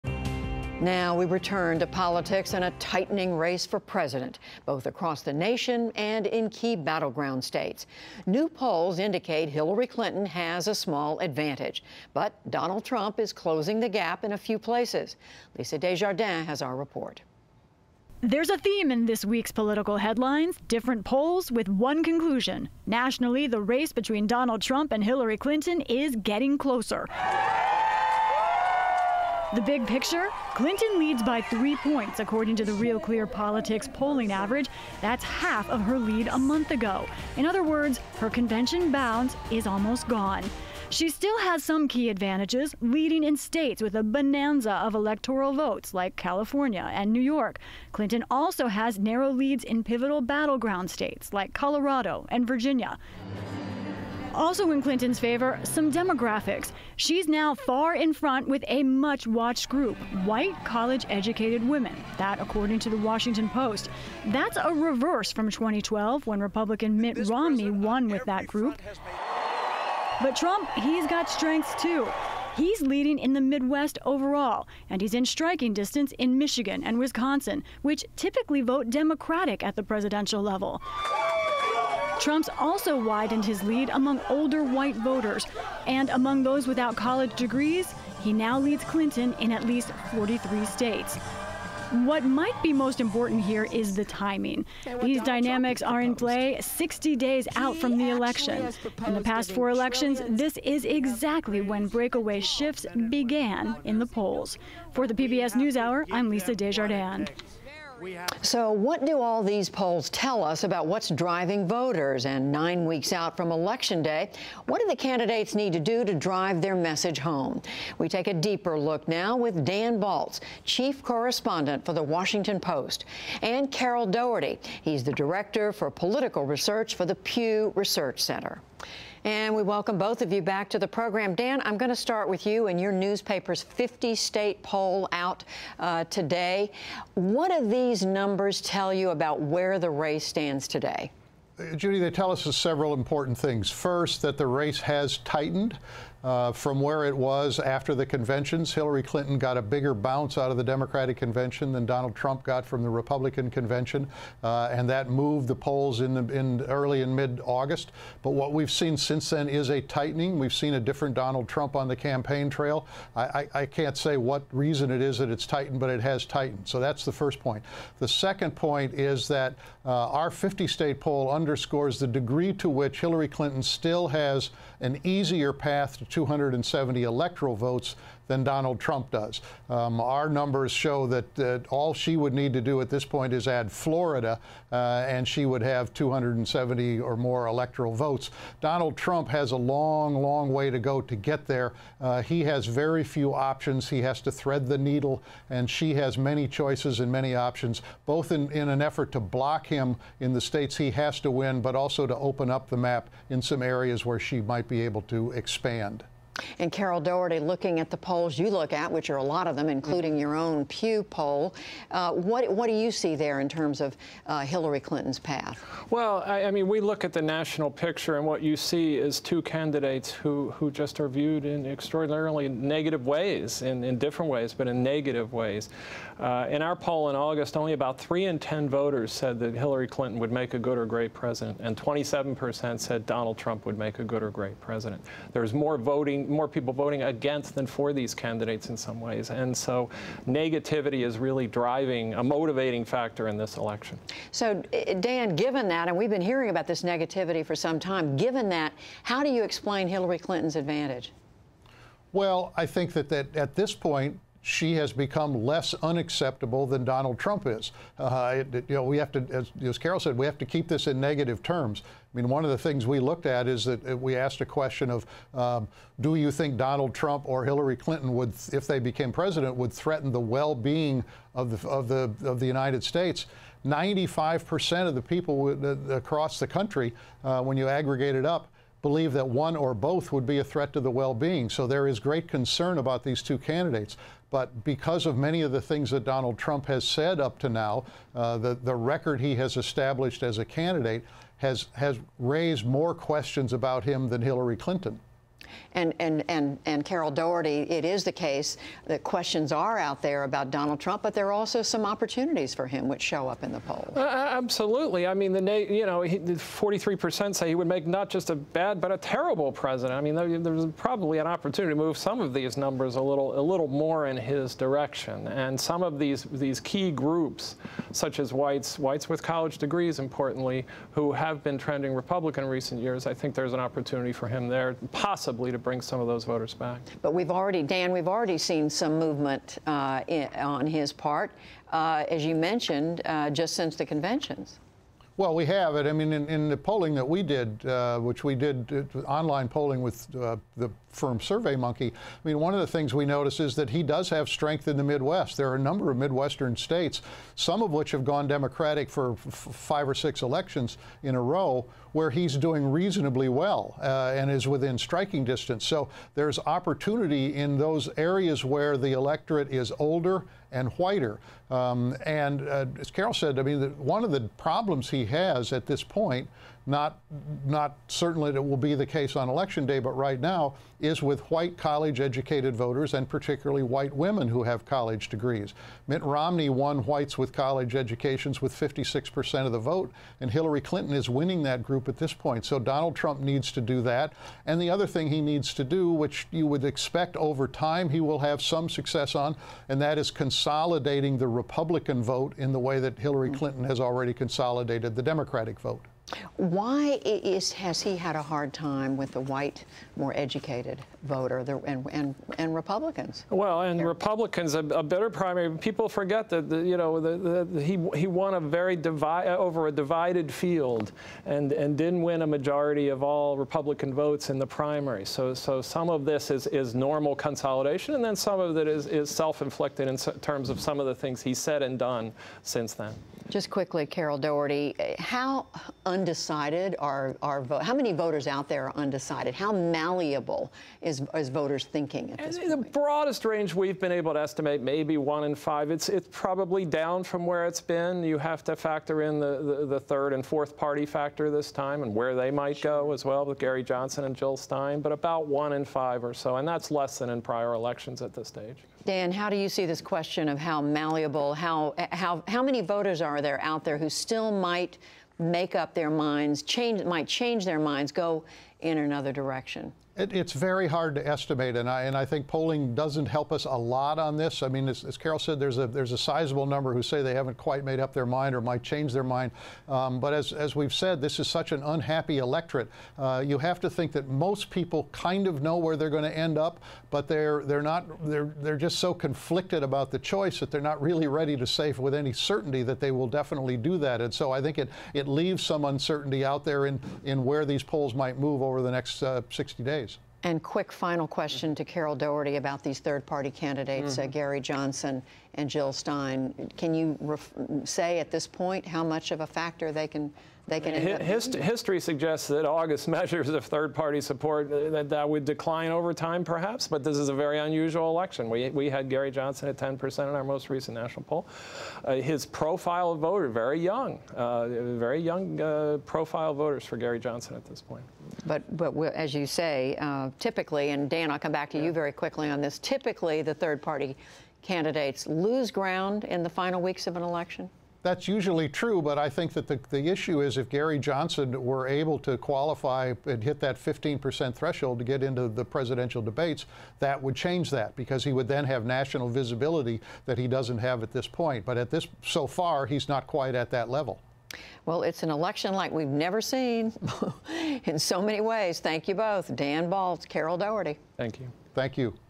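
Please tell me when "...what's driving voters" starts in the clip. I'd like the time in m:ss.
1:50.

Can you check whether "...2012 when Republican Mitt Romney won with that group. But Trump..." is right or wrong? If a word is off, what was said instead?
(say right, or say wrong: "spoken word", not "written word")
right.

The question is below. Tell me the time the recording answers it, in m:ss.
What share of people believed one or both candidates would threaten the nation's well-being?
4:33.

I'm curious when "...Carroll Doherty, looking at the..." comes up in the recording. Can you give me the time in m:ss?
3:26.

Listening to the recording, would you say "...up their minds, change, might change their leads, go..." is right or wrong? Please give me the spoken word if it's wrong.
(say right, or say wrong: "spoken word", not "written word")
wrong: "minds", not "leads".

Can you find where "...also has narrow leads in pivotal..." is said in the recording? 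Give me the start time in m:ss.
0:48.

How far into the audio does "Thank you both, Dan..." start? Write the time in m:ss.
9:08.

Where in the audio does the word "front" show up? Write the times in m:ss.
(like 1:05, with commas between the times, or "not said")
0:58.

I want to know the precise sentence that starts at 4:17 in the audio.
Uh, it, it, you know, we have to, as, as, Carroll said, we have to keep this in negative terms.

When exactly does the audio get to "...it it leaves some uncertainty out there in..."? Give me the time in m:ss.
8:04.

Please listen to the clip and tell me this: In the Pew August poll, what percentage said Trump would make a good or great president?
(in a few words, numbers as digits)
27 percent.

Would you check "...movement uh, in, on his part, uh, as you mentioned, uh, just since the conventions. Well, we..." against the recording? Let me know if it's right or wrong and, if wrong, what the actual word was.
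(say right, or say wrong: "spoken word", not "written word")
right.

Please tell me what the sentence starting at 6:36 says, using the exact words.
Why is, has he had a hard time with the white, more educated voter the, and, and, and Republicans?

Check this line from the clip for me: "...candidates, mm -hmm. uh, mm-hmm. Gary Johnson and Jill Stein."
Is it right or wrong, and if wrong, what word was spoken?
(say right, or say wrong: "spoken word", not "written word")
right.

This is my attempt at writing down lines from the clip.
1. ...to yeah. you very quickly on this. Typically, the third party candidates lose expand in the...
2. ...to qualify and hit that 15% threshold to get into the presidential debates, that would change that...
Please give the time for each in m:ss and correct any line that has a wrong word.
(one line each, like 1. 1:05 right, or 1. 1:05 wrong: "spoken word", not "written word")
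1. 8:41 wrong: "ground", not "expand"
2. 8:51 right.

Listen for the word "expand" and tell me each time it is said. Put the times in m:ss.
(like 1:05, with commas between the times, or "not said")
3:25.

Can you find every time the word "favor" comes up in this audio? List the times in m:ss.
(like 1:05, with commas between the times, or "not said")
0:55.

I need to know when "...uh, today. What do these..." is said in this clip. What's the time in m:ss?
2:15.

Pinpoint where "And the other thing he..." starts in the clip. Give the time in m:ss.
6:24.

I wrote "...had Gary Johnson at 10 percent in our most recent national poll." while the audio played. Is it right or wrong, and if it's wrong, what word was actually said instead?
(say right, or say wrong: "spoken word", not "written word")
right.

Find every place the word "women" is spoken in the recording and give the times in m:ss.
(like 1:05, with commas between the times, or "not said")
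1:01, 6:13.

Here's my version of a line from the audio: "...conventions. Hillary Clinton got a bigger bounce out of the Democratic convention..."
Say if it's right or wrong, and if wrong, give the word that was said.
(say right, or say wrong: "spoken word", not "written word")
right.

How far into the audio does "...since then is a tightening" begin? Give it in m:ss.
2:38.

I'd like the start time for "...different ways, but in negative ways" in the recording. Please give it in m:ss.
3:43.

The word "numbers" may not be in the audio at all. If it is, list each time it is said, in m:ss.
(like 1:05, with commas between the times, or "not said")
2:18, 3:00, 5:12, 5:45, 7:46.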